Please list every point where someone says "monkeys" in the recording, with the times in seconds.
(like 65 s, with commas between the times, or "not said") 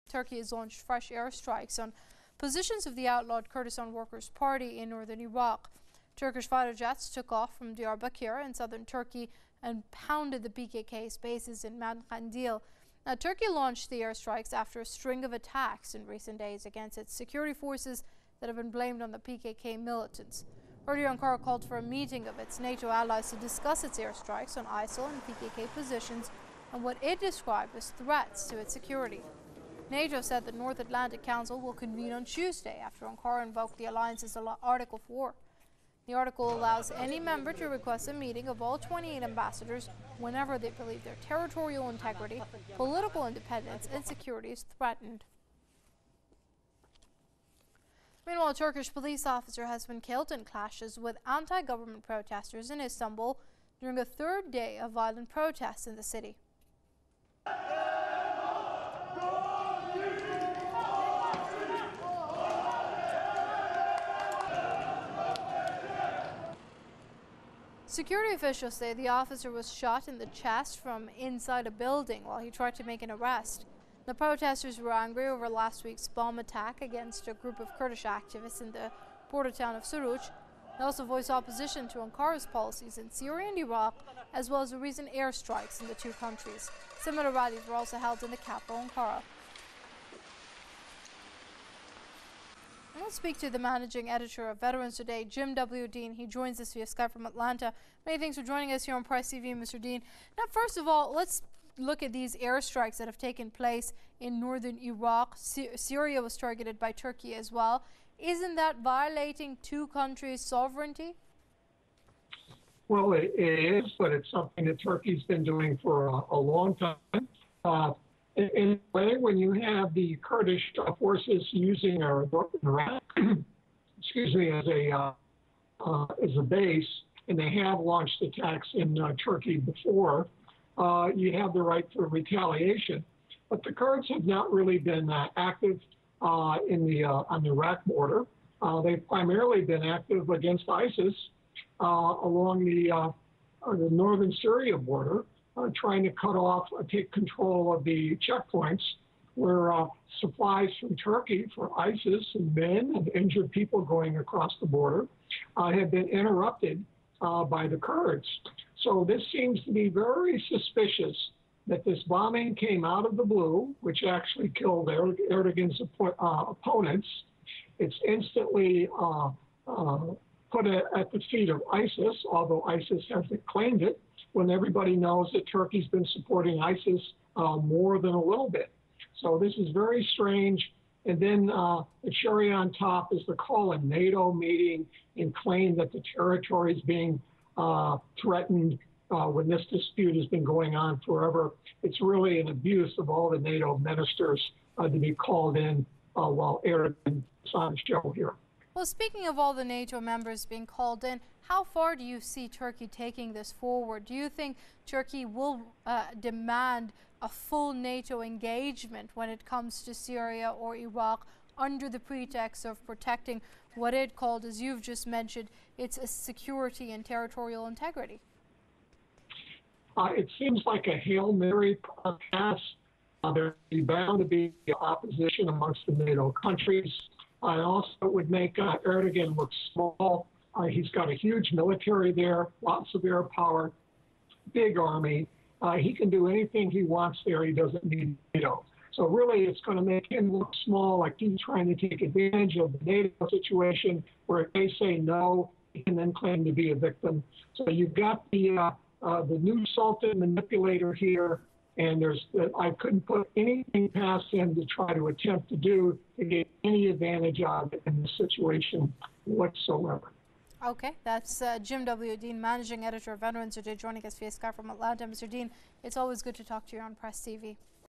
not said.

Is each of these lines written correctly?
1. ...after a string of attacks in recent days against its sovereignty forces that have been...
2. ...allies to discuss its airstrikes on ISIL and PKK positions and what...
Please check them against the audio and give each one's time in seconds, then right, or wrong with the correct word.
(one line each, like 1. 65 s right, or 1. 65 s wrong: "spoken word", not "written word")
1. 14 s wrong: "security", not "sovereignty"
2. 22 s right.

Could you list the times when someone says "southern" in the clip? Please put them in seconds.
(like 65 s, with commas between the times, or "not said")
8 s.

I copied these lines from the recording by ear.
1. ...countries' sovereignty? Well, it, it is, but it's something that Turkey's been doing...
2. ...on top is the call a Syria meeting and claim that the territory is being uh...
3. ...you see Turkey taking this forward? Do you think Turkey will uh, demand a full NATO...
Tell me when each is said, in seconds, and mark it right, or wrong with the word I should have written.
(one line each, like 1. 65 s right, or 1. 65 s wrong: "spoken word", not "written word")
1. 109 s right
2. 182 s wrong: "NATO", not "Syria"
3. 202 s right.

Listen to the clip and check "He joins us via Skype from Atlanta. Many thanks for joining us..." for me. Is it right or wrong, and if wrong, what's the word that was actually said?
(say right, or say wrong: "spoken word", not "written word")
right.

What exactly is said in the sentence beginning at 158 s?
So this seems to be very suspicious that this bombing came out of the blue, which actually killed er-, Erdogan's uh, opponents.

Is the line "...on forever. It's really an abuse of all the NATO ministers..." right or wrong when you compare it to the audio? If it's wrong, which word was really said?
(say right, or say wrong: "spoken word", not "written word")
right.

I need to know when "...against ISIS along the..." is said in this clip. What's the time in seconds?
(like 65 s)
140 s.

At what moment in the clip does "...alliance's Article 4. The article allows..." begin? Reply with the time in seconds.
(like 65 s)
33 s.